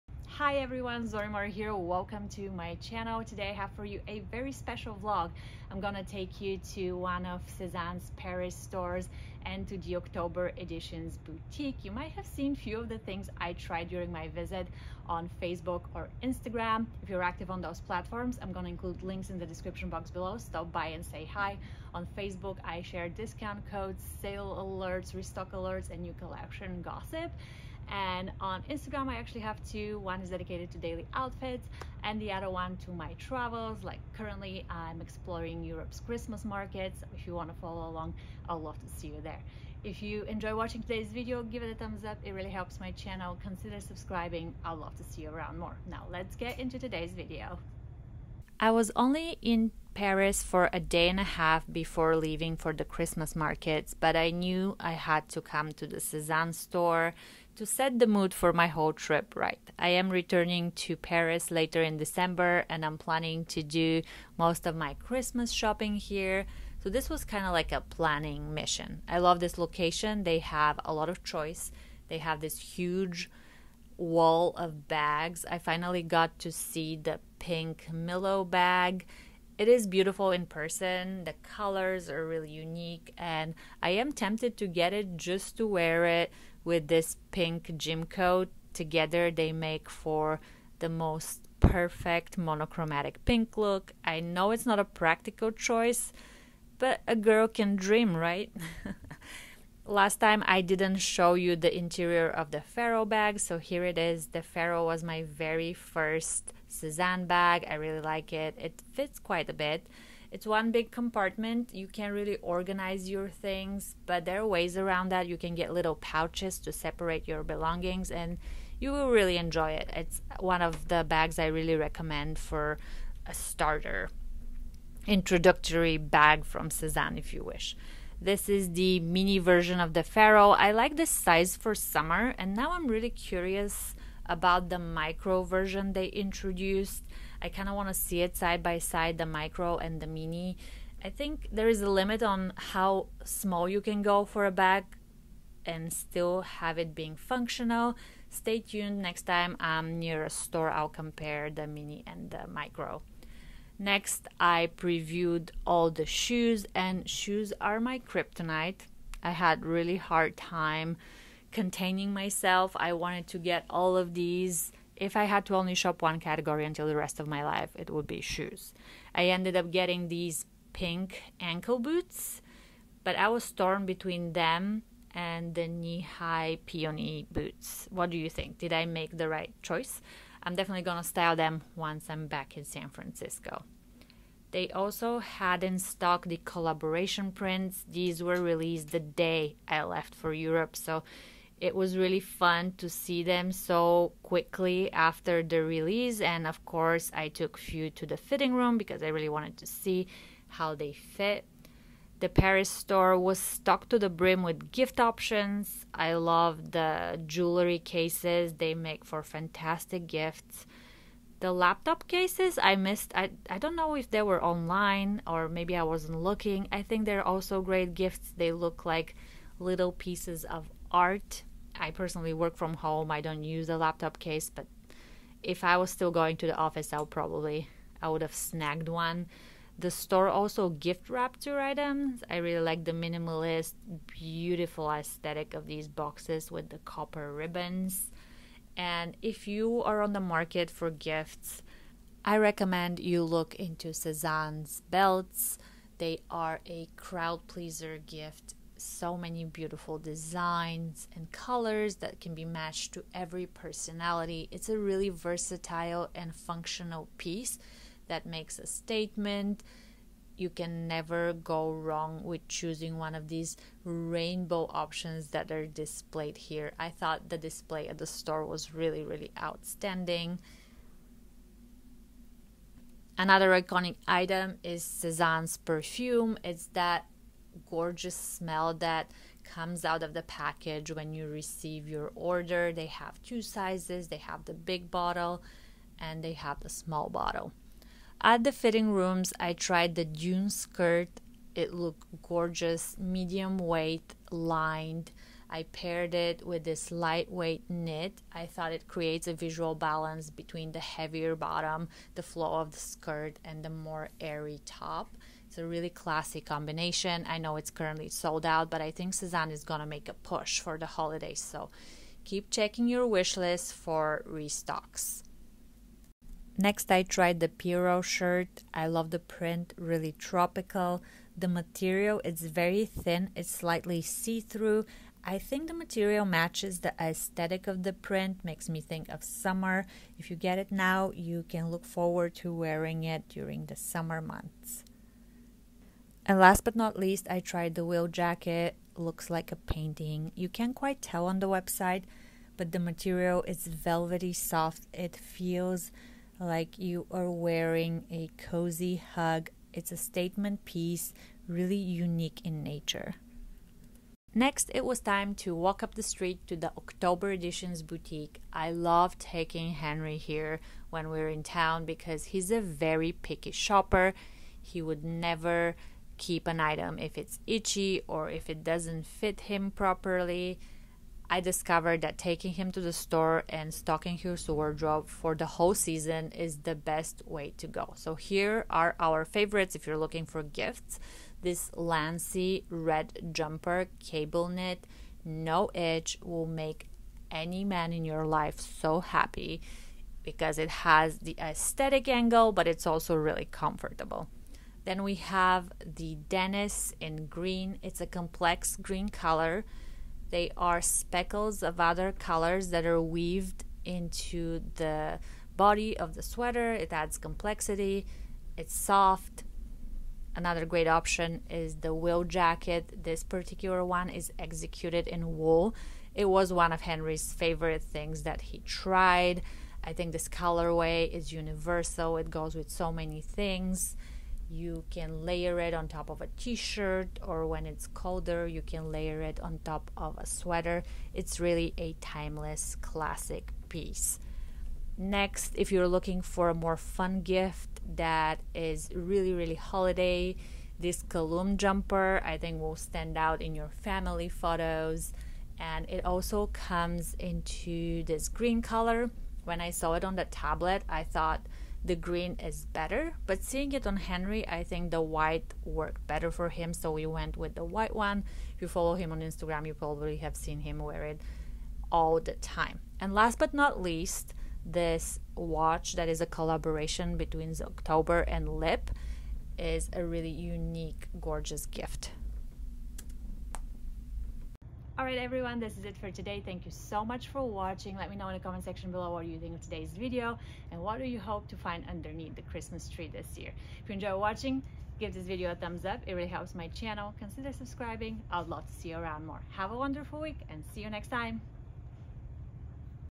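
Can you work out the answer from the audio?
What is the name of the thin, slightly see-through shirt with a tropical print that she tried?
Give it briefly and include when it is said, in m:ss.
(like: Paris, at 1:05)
Pierro shirt, at 5:17.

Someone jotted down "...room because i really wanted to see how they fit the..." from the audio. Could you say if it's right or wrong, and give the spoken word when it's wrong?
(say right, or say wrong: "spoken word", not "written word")
right.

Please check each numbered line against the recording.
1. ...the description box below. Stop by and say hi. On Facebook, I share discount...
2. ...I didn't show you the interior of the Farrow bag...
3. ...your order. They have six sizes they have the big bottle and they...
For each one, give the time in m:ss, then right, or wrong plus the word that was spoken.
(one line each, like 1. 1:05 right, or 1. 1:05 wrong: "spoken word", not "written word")
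1. 0:19 right
2. 1:40 right
3. 4:41 wrong: "two", not "six".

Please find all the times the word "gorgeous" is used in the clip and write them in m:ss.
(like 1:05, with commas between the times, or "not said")
4:37, 4:52, 7:51.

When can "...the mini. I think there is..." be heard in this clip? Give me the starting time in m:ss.
2:19.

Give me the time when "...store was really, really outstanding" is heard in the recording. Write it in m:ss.
4:28.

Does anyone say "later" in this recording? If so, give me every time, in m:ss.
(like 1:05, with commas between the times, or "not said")
1:01.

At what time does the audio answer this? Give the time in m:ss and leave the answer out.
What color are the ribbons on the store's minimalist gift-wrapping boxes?
3:56.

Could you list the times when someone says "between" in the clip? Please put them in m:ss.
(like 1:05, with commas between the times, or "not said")
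2:53, 5:00, 7:47.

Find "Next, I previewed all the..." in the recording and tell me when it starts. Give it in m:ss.
2:33.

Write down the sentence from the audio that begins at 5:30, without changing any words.
If you get it now, you can look forward to wearing it during the summer months.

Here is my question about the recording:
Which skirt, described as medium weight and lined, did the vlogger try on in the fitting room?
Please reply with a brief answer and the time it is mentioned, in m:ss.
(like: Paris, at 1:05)
Dune skirt, at 4:50.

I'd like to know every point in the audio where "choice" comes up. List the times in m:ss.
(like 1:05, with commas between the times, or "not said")
1:11, 1:35, 2:59.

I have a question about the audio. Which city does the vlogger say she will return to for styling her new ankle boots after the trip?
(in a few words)
San Francisco.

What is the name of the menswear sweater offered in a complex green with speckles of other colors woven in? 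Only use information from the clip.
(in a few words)
Denis.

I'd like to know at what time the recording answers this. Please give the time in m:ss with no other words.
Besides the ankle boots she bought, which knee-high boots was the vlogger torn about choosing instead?
2:56.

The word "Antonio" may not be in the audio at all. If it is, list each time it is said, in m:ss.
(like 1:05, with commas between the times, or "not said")
not said.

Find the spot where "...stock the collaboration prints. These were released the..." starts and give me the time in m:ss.
3:05.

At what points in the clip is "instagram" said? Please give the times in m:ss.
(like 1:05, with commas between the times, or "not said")
0:16, 0:28, 7:39.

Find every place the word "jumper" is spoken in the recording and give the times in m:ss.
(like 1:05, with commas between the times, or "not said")
6:23, 7:21.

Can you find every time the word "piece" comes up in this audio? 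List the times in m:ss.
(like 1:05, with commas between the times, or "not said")
3:39, 4:17, 5:50, 7:13.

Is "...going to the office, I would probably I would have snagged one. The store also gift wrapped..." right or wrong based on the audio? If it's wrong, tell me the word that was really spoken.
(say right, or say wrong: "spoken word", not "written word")
right.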